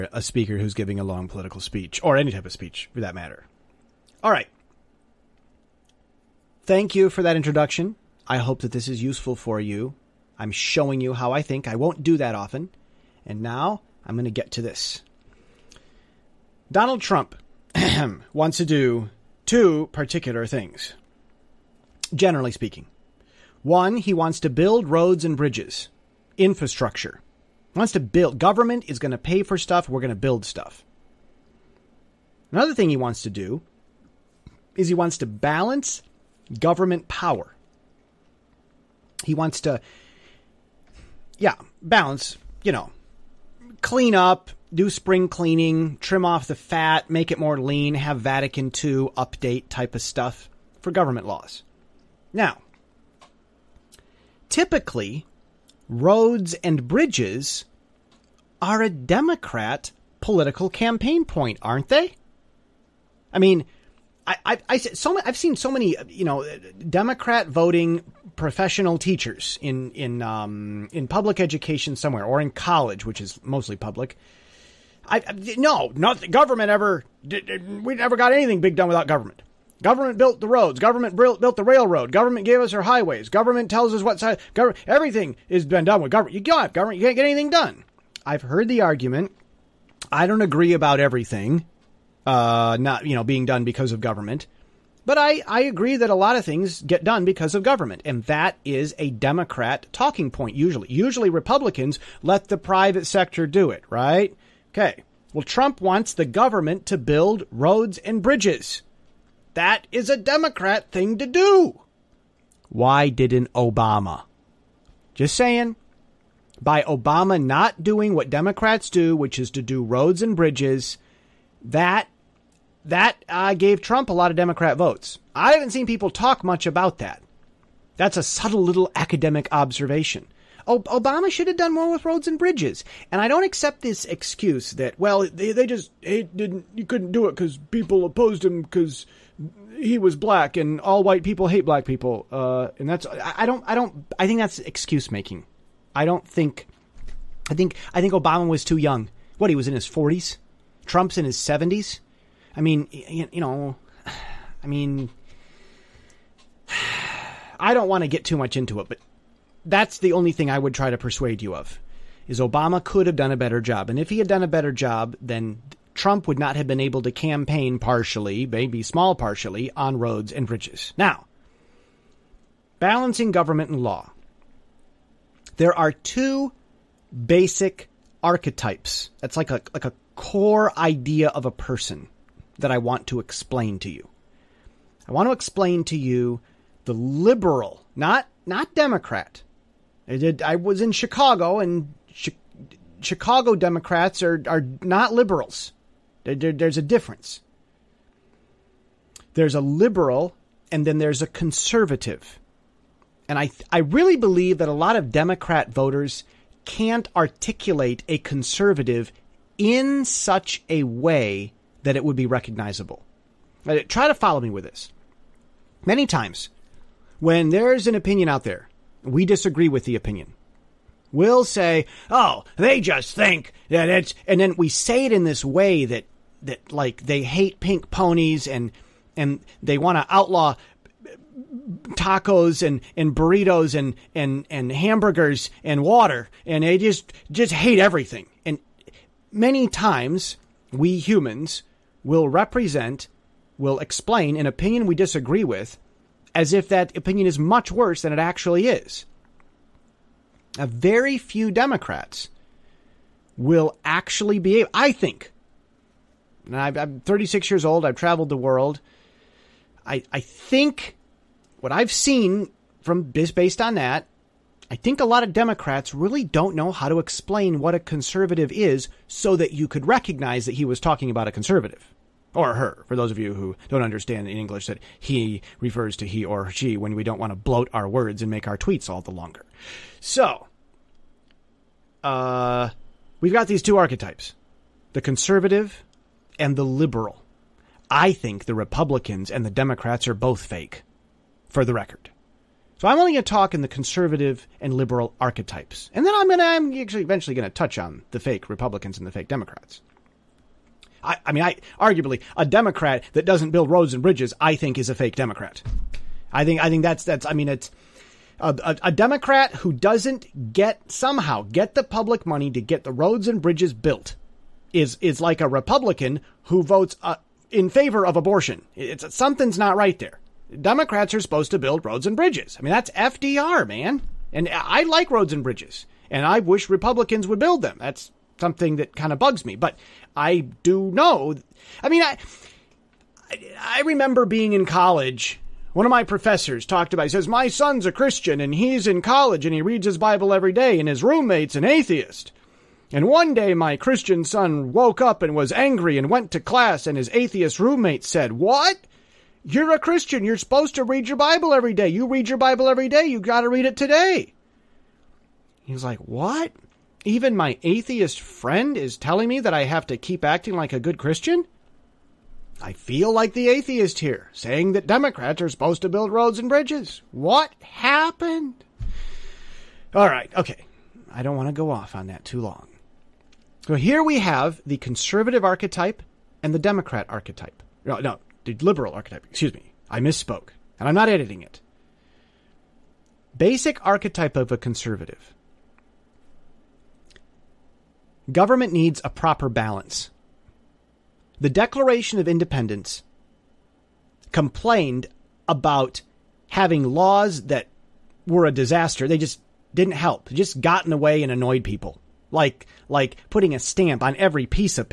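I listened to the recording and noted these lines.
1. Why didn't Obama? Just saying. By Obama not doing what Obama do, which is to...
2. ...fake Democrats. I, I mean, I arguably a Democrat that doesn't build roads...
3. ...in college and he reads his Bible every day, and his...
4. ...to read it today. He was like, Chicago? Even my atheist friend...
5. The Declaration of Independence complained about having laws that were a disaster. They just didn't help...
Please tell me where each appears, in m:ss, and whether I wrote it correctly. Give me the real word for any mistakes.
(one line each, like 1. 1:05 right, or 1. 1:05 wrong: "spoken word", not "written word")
1. 1:52 wrong: "Democrats", not "Obama"
2. 4:59 right
3. 5:38 right
4. 5:53 wrong: "What", not "Chicago"
5. 6:31 right.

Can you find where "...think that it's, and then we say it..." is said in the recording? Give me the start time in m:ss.
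3:43.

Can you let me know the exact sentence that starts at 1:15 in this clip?
I, I no, not the government ever.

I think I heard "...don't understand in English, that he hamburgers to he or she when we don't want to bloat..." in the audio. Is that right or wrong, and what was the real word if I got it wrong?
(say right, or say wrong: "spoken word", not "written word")
wrong: "refers", not "hamburgers".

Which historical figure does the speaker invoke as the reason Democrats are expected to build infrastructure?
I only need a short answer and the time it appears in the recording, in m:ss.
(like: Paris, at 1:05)
FDR, at 5:22.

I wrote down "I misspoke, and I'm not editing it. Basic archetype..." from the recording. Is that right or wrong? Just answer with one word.
right.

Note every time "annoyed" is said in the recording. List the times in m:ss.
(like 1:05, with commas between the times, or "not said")
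6:41.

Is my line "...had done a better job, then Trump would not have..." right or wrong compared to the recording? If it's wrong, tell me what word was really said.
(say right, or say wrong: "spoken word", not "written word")
right.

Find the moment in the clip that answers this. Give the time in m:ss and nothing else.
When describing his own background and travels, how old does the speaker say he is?
4:17.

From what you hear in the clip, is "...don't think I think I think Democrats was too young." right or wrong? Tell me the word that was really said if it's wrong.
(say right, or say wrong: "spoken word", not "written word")
wrong: "Obama", not "Democrats".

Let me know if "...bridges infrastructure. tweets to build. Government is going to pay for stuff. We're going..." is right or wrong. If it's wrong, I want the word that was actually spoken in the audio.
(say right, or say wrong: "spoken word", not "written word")
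wrong: "wants", not "tweets".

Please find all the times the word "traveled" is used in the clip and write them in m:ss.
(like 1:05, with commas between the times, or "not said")
4:17.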